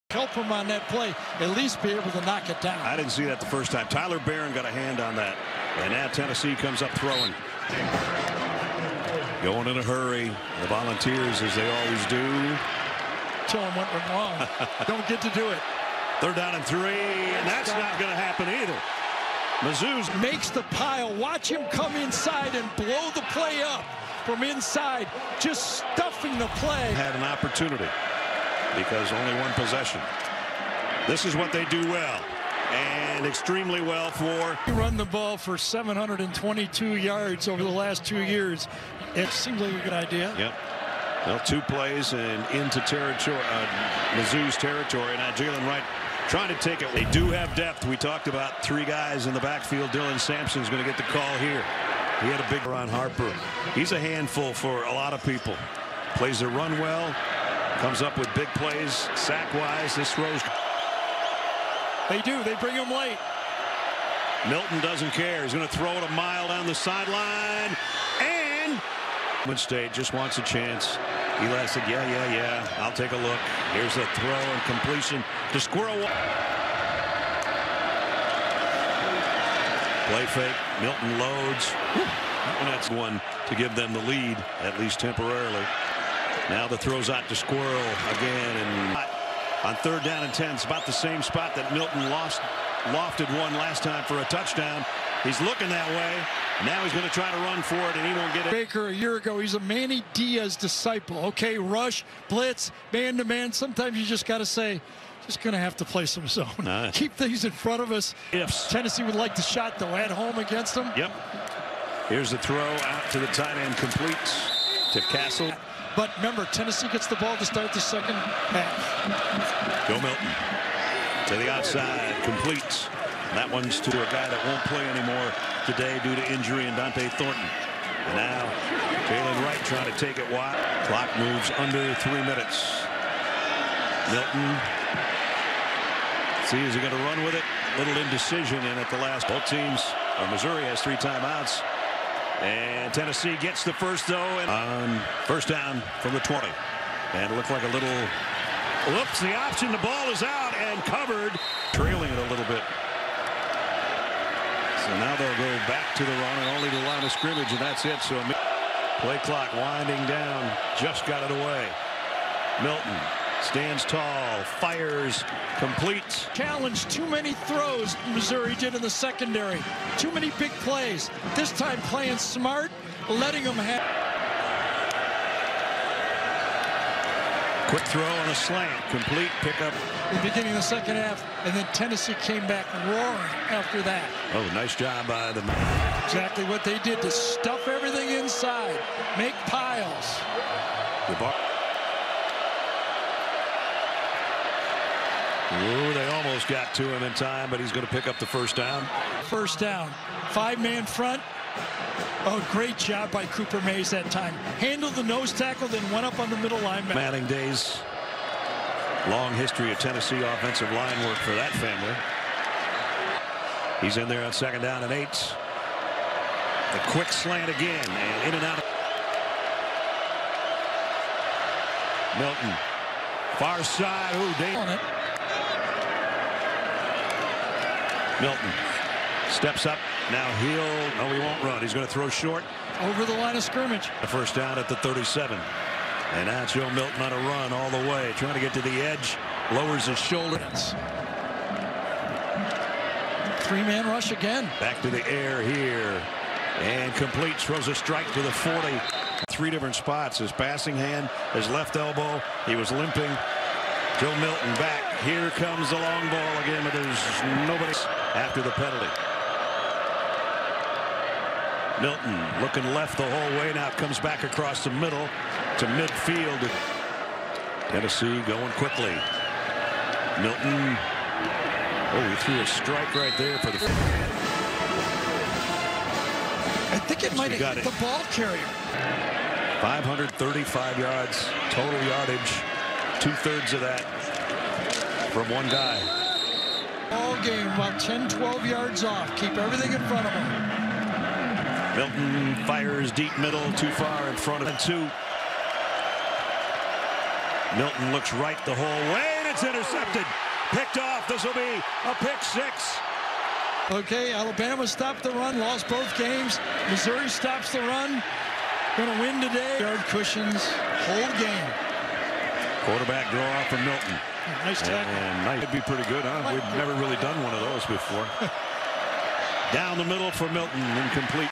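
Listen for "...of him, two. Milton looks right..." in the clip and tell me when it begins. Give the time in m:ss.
4:54.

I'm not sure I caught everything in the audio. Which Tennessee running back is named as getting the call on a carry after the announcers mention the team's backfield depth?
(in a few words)
Dylan Sampson.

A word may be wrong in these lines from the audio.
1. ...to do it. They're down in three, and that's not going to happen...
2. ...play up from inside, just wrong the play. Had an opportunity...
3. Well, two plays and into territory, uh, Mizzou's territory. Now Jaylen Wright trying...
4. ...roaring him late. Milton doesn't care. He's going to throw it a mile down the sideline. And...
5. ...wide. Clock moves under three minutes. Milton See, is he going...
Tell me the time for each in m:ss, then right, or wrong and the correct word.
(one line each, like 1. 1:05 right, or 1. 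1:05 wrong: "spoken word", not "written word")
1. 0:15 right
2. 0:23 wrong: "stuffing", not "wrong"
3. 0:41 right
4. 1:02 wrong: "bring", not "roaring"
5. 2:10 right.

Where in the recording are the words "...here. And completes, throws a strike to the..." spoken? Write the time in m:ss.
4:05.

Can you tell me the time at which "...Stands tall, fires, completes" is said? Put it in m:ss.
2:43.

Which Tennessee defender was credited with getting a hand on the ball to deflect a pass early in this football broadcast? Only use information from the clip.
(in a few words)
Tyler Baron.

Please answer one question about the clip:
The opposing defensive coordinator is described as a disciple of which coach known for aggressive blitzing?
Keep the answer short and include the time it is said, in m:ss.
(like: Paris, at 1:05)
Manny Diaz, at 1:39.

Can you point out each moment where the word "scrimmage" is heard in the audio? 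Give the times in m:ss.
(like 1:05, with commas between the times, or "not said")
2:37, 3:53.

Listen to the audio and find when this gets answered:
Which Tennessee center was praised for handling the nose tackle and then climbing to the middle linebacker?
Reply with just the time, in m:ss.
3:23.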